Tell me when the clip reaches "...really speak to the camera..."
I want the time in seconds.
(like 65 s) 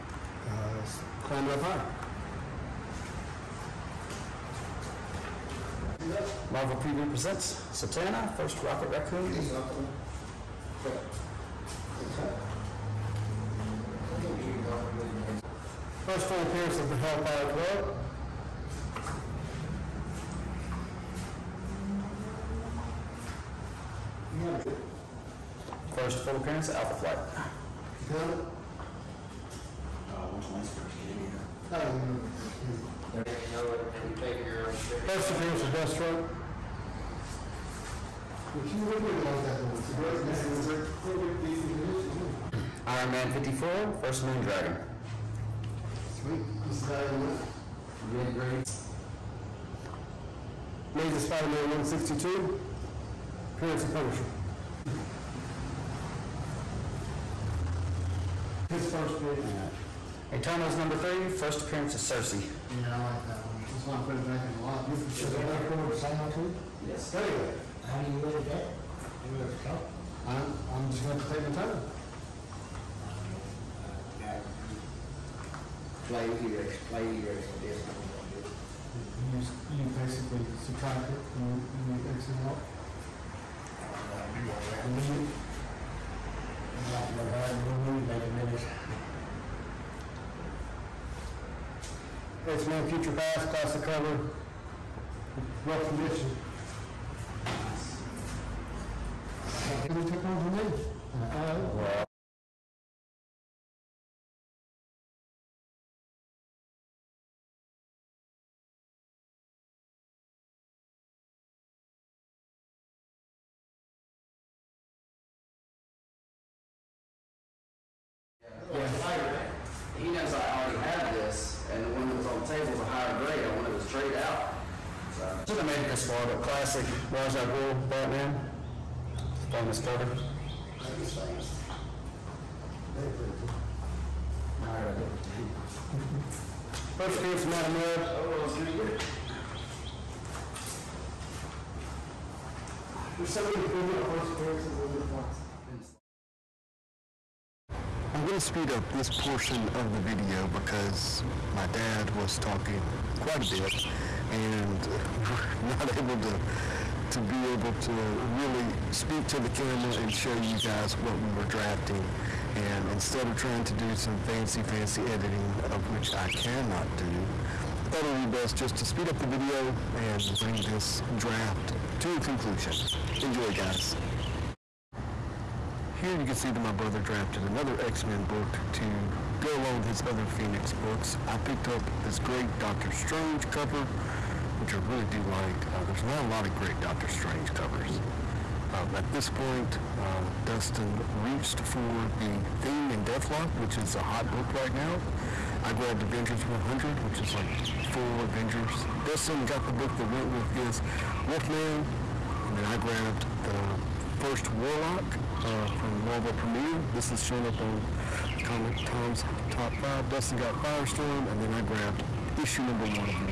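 158 s.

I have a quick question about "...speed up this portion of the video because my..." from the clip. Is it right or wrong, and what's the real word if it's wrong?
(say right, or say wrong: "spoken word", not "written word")
right.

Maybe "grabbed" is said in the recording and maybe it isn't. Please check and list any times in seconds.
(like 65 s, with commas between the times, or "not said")
195 s, 202 s, 211 s.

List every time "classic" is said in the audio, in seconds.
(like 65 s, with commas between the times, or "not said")
93 s, 126 s.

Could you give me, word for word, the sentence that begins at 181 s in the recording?
I picked up this great Doctor Strange cover, which I really do like.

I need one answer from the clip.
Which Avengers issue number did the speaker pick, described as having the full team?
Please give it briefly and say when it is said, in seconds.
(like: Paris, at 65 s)
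100, at 196 s.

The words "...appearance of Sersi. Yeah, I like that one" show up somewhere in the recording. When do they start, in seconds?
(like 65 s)
61 s.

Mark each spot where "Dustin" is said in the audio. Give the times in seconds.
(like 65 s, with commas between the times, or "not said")
190 s, 199 s, 210 s.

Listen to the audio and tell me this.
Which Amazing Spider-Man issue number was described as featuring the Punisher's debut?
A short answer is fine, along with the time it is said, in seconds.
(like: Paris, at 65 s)
162, at 50 s.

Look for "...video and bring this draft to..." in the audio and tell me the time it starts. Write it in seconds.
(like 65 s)
169 s.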